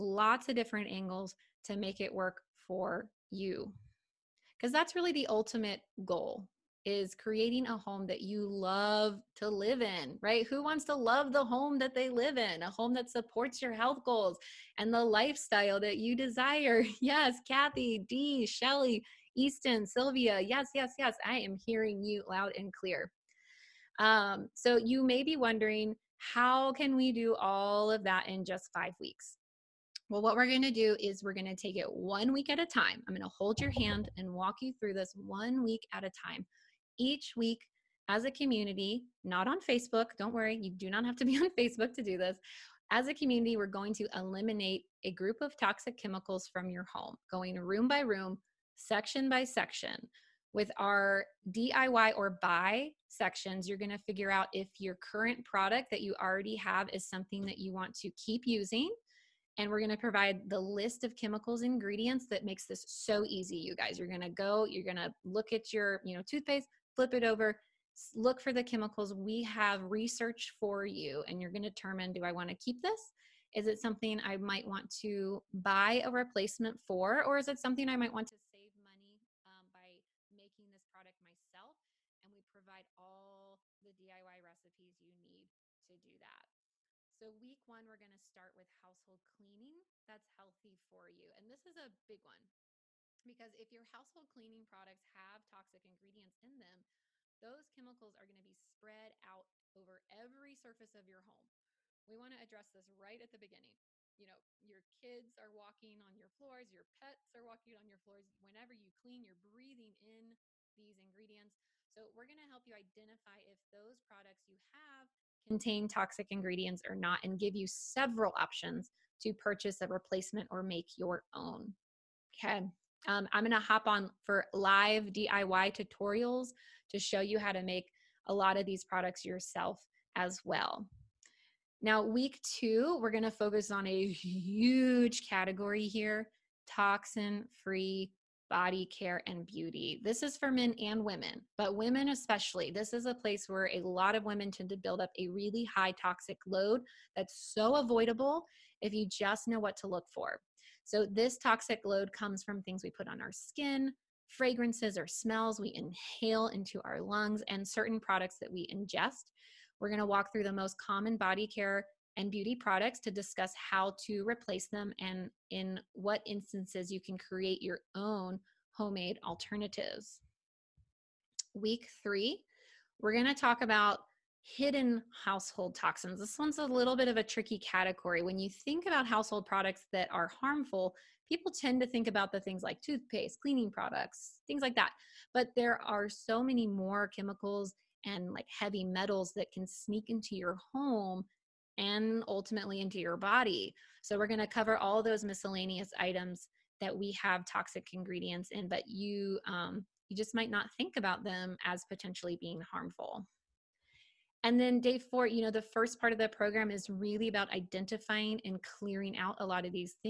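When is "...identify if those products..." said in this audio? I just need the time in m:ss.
1:52.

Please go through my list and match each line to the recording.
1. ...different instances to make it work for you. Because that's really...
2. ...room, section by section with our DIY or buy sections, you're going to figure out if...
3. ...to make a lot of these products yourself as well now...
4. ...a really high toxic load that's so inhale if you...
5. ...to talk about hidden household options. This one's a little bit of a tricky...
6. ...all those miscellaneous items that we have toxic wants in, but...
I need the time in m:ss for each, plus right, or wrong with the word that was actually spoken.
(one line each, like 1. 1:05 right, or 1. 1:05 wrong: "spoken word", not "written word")
1. 0:00 wrong: "angles", not "instances"
2. 0:47 right
3. 2:07 right
4. 2:25 wrong: "avoidable", not "inhale"
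5. 2:53 wrong: "toxins", not "options"
6. 3:14 wrong: "ingredients", not "wants".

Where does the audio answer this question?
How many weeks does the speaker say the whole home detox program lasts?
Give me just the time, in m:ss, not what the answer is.
0:28.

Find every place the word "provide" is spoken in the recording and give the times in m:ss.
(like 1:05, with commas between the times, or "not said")
0:59, 1:22.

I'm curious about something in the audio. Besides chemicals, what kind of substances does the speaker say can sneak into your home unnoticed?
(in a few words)
Heavy metals.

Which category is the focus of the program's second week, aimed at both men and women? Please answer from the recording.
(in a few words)
Toxin free body care and beauty.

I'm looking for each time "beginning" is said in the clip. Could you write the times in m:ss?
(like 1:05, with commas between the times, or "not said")
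1:43.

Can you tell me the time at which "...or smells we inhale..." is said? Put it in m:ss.
2:34.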